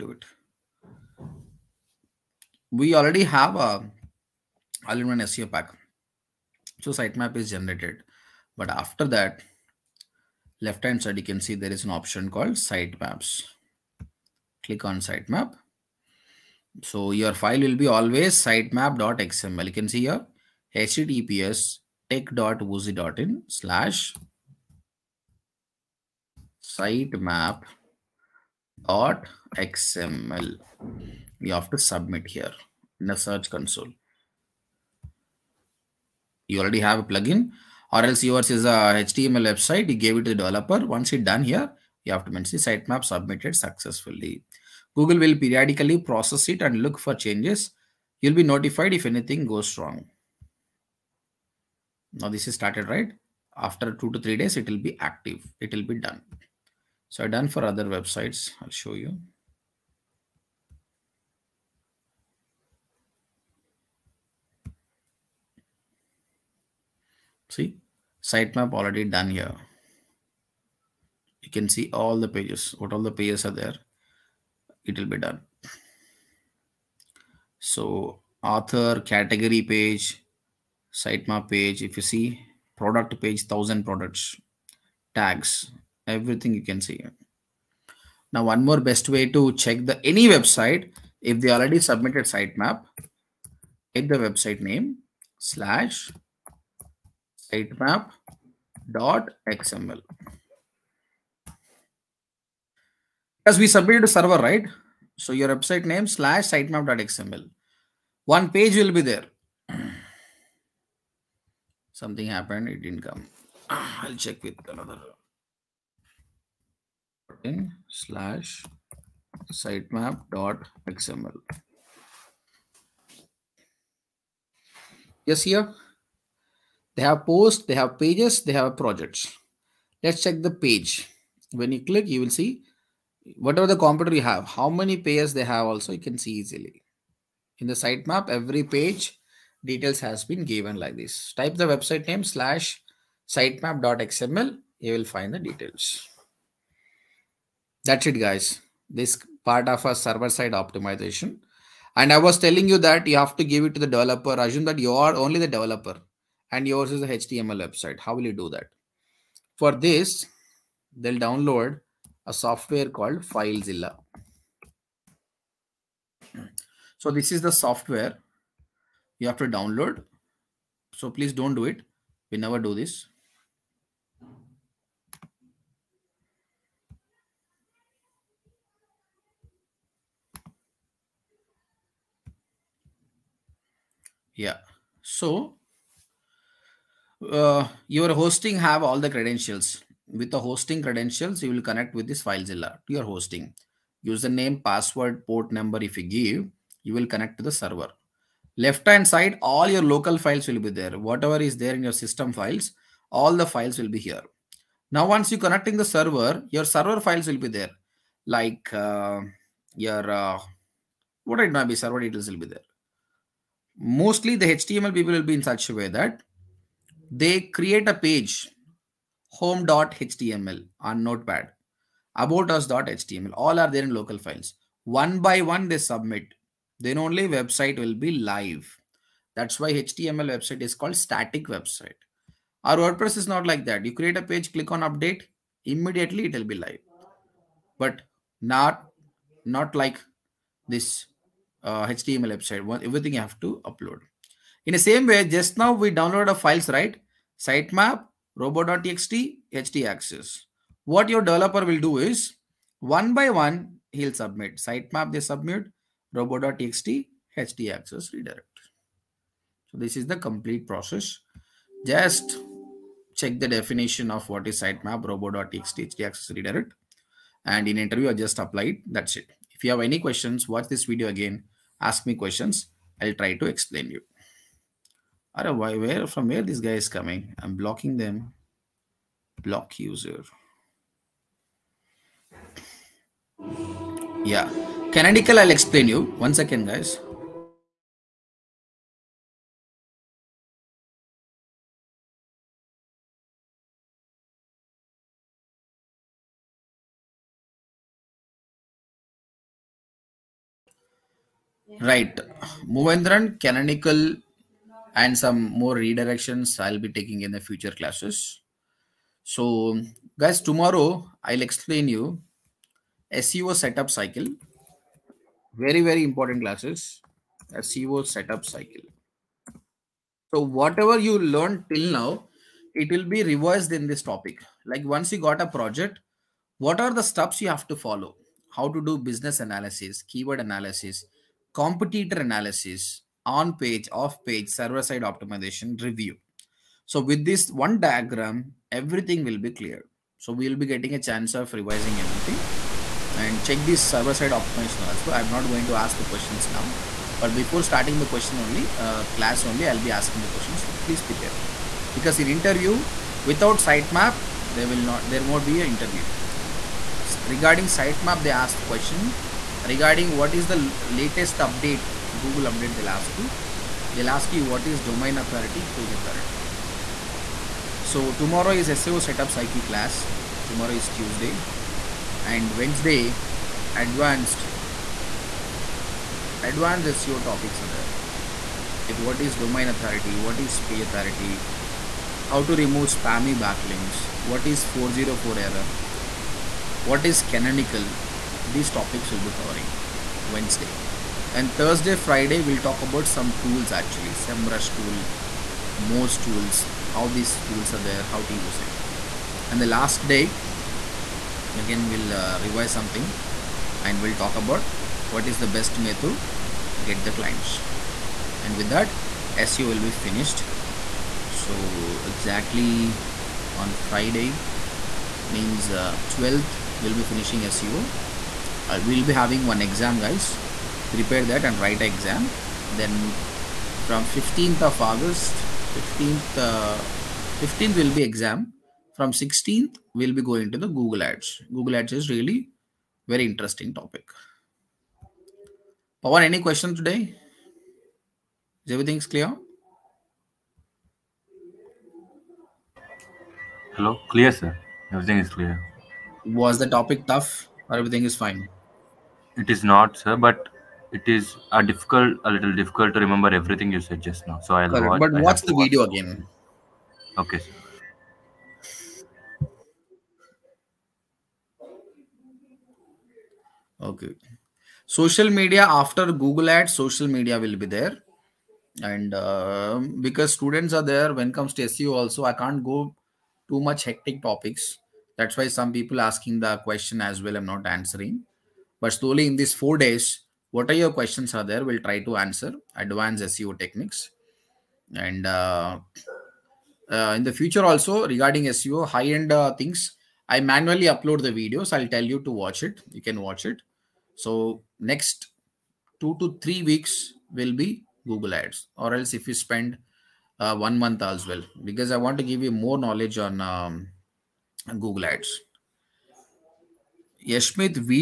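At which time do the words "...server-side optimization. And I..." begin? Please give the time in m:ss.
2:29.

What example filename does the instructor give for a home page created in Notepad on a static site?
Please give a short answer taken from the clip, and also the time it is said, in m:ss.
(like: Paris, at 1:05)
home.html, at 3:39.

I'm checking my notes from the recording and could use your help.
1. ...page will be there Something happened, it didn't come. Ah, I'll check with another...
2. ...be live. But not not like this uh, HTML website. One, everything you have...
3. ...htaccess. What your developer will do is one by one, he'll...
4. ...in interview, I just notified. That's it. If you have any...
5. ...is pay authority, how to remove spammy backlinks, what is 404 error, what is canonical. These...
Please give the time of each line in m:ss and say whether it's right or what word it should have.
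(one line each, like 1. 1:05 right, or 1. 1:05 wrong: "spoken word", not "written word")
1. 1:48 right
2. 3:56 right
3. 4:09 right
4. 4:27 wrong: "applied", not "notified"
5. 6:20 right.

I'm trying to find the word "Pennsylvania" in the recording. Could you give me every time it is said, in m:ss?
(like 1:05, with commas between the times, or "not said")
not said.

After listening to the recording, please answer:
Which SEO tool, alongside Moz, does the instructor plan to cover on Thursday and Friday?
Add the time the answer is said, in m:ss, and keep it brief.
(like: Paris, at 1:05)
SEMrush, at 6:34.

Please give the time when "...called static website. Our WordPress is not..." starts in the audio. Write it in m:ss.
3:50.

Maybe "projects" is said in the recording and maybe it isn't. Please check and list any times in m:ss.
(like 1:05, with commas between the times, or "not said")
2:08, 5:25.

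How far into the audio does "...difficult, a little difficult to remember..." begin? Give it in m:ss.
7:31.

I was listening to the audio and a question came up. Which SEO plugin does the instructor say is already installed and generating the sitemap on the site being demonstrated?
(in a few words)
All-in-One SEO Pack.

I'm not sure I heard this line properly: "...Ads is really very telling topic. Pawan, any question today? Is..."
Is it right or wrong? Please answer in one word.
wrong.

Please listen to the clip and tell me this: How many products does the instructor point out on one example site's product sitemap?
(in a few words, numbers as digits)
1000.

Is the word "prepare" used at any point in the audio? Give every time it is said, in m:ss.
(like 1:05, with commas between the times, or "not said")
5:51, 7:00.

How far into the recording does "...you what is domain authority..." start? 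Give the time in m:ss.
6:04.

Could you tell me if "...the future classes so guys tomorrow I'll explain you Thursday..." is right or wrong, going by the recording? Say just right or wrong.
wrong.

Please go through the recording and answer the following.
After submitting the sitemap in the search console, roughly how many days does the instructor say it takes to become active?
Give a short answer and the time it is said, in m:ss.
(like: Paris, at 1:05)
2 to 3 days, at 0:53.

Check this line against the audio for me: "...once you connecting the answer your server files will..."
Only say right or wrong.
wrong.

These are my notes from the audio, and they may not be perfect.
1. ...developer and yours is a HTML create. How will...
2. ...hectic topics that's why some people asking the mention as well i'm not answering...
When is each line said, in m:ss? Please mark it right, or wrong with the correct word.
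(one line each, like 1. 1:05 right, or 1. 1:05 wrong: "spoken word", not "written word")
1. 2:35 wrong: "website", not "create"
2. 7:53 wrong: "question", not "mention".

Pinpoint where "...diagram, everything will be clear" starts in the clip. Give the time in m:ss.
5:37.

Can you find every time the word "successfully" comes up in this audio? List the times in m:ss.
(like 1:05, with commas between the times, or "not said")
0:43.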